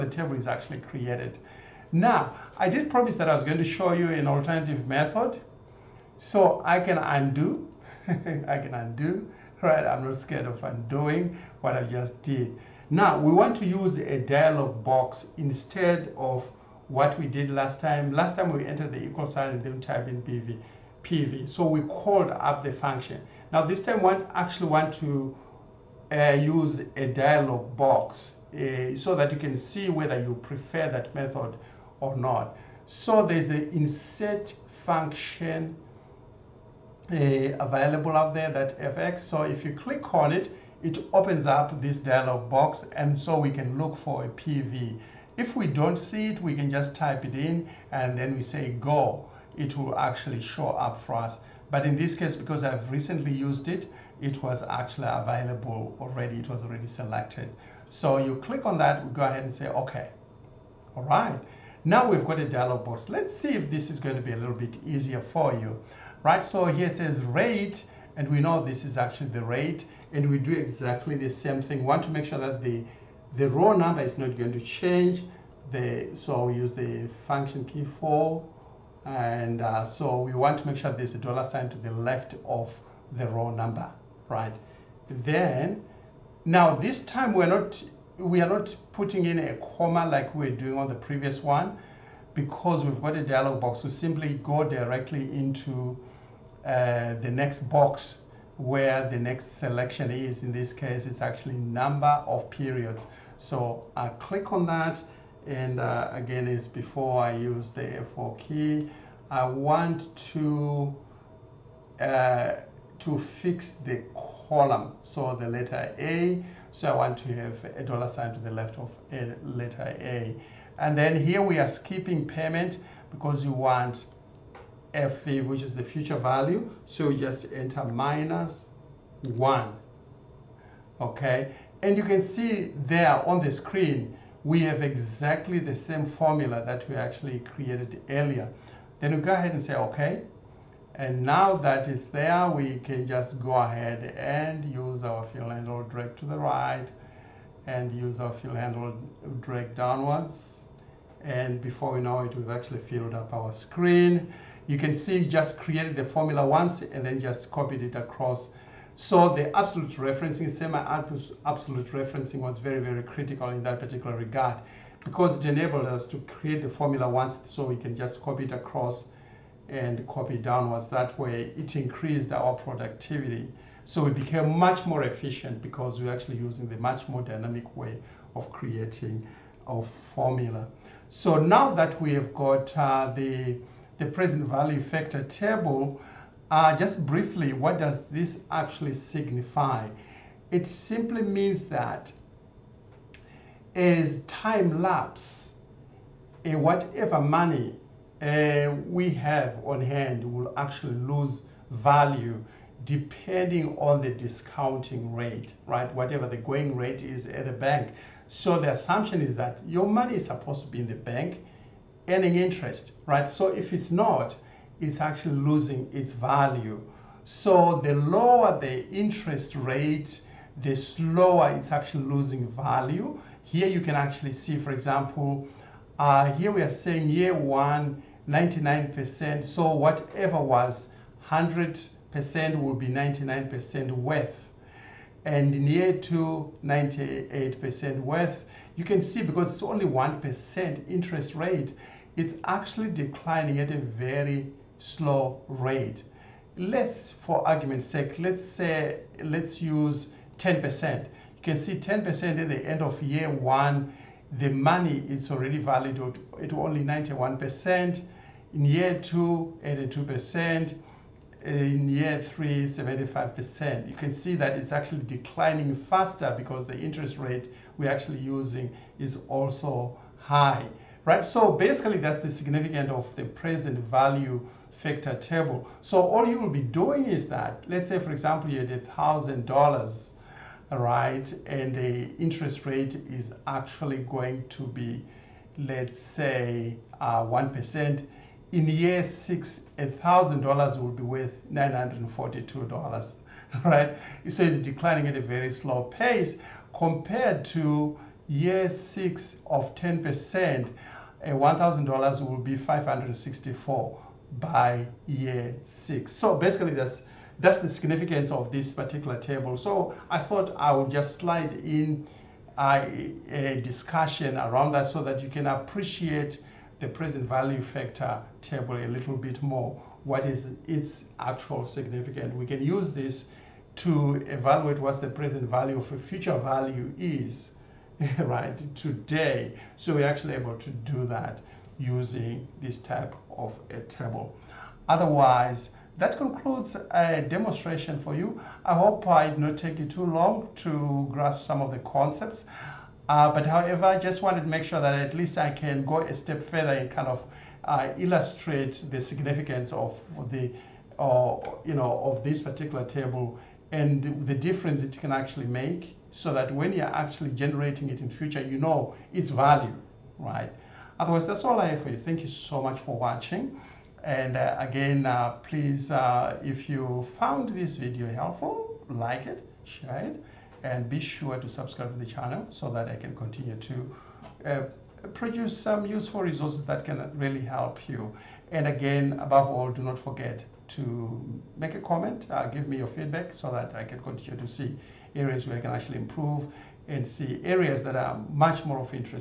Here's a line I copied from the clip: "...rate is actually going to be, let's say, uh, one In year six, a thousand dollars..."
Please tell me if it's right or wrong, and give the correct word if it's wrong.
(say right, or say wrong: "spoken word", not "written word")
right.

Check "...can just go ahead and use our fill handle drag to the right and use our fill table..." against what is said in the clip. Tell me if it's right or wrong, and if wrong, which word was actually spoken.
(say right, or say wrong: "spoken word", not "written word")
wrong: "handle", not "table".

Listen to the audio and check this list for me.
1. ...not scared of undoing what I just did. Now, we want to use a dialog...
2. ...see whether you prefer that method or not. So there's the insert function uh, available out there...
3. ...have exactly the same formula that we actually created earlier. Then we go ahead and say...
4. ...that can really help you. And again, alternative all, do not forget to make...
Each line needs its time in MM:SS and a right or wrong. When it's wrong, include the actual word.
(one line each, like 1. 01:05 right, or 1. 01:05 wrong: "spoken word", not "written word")
1. 00:10 right
2. 00:29 right
3. 02:14 right
4. 06:16 wrong: "above", not "alternative".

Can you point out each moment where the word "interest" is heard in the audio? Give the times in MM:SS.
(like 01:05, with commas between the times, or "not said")
03:32, 03:38, 04:00, 04:26, 04:42.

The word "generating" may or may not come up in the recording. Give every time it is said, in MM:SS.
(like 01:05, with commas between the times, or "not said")
05:57.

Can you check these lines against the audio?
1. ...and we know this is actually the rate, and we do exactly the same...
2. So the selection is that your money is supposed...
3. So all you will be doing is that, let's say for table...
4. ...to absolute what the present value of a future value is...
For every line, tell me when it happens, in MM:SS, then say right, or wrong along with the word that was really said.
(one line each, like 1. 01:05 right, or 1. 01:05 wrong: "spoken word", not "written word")
1. 01:08 right
2. 03:28 wrong: "assumption", not "selection"
3. 04:35 wrong: "example", not "table"
4. 05:23 wrong: "evaluate", not "absolute".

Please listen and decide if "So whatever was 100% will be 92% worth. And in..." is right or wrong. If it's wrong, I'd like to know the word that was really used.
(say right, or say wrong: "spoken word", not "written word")
wrong: "99", not "92".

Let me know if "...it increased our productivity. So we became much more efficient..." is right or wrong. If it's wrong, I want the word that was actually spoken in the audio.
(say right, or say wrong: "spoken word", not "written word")
right.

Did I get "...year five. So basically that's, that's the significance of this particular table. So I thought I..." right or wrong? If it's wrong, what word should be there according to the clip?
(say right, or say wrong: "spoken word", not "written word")
wrong: "six", not "five".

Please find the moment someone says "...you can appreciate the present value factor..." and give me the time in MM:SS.
05:15.